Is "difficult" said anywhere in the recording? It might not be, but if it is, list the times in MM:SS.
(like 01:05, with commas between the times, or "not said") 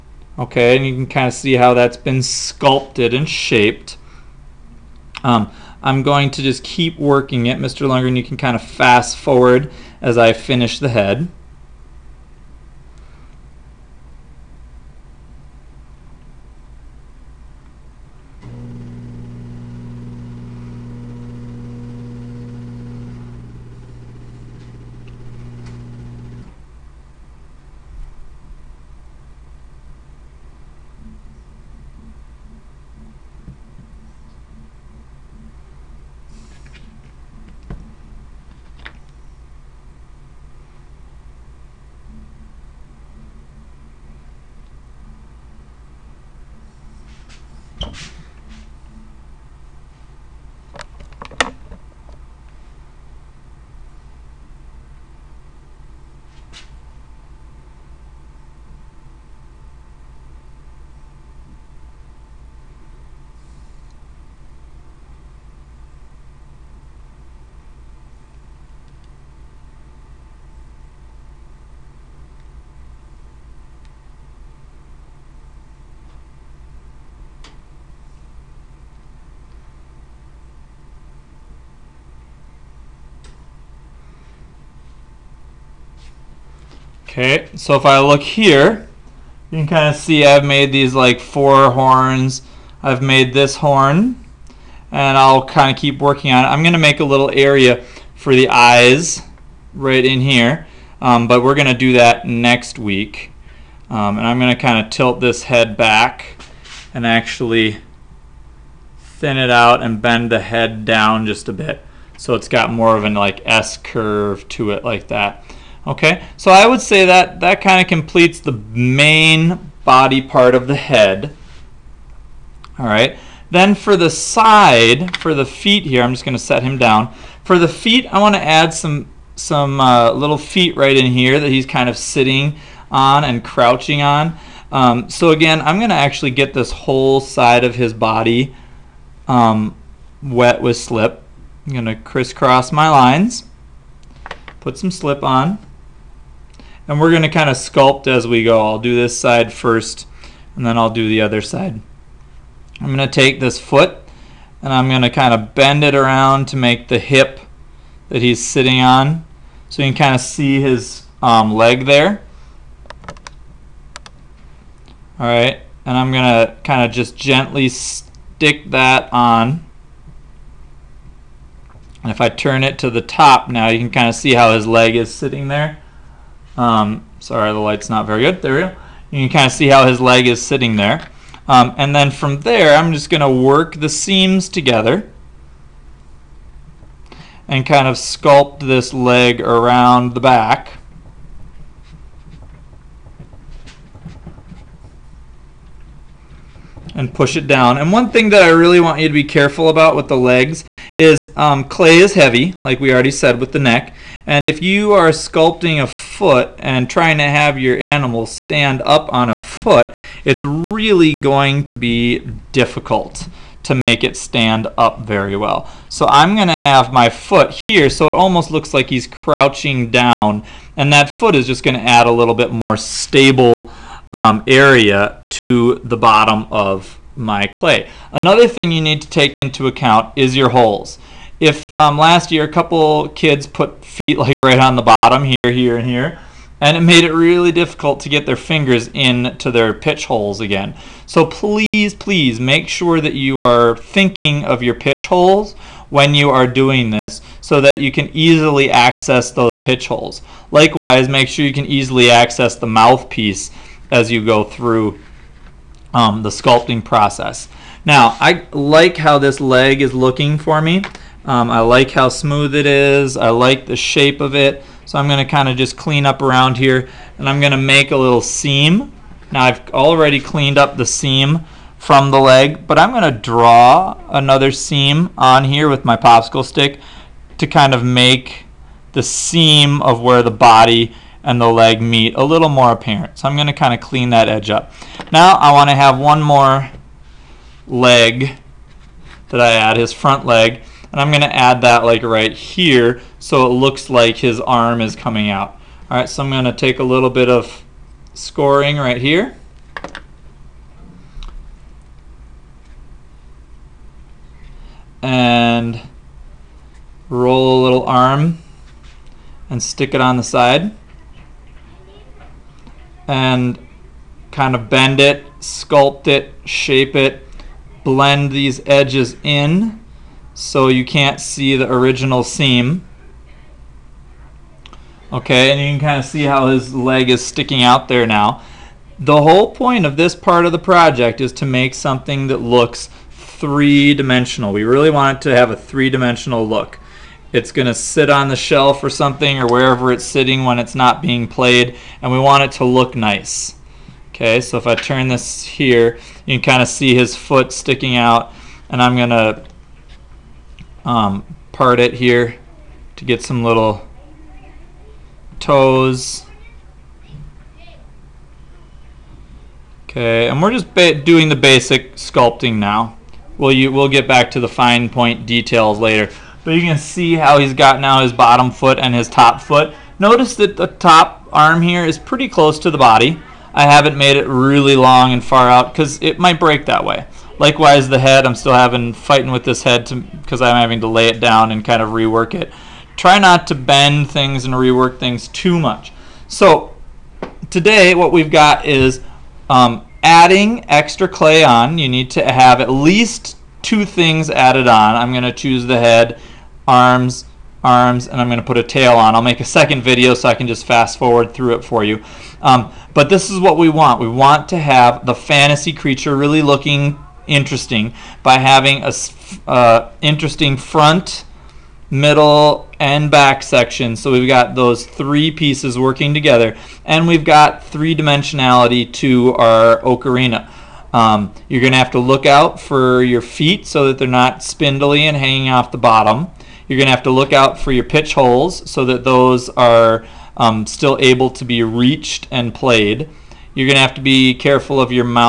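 03:32, 03:57.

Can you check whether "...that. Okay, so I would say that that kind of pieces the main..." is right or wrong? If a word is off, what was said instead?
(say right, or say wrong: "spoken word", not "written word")
wrong: "completes", not "pieces".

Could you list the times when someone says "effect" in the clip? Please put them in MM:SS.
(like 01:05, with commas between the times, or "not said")
not said.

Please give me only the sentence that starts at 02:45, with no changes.
Alright, and I'm going to kind of just gently stick that on.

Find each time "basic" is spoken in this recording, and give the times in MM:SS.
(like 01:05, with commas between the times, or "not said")
06:01.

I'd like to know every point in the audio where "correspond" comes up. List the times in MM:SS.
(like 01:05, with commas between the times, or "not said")
not said.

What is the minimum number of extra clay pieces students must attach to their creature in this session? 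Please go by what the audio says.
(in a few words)
2.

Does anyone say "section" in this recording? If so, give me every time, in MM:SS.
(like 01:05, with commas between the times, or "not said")
06:53.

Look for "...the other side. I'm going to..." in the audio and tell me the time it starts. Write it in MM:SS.
02:31.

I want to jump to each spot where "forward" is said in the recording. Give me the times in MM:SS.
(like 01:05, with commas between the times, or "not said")
00:09, 06:40.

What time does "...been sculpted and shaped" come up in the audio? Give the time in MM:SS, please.
00:01.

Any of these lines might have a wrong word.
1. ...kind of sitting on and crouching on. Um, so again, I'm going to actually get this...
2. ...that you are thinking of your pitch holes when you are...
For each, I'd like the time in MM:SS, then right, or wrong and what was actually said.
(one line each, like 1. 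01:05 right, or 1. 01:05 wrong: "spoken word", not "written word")
1. 02:11 right
2. 04:02 right.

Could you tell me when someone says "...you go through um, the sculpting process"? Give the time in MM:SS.
04:14.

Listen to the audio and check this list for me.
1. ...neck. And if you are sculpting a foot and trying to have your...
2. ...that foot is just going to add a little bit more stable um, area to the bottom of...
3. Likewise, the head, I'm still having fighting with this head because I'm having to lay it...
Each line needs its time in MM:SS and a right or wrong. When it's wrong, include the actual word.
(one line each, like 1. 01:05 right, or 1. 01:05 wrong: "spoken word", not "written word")
1. 03:23 right
2. 03:40 right
3. 06:17 right.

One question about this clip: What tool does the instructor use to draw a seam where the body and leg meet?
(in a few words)
Popsicle stick.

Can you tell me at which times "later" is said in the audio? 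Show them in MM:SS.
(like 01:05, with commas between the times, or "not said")
06:05.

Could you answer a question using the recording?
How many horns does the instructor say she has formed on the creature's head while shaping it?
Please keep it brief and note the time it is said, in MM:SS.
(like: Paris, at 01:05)
4, at 01:31.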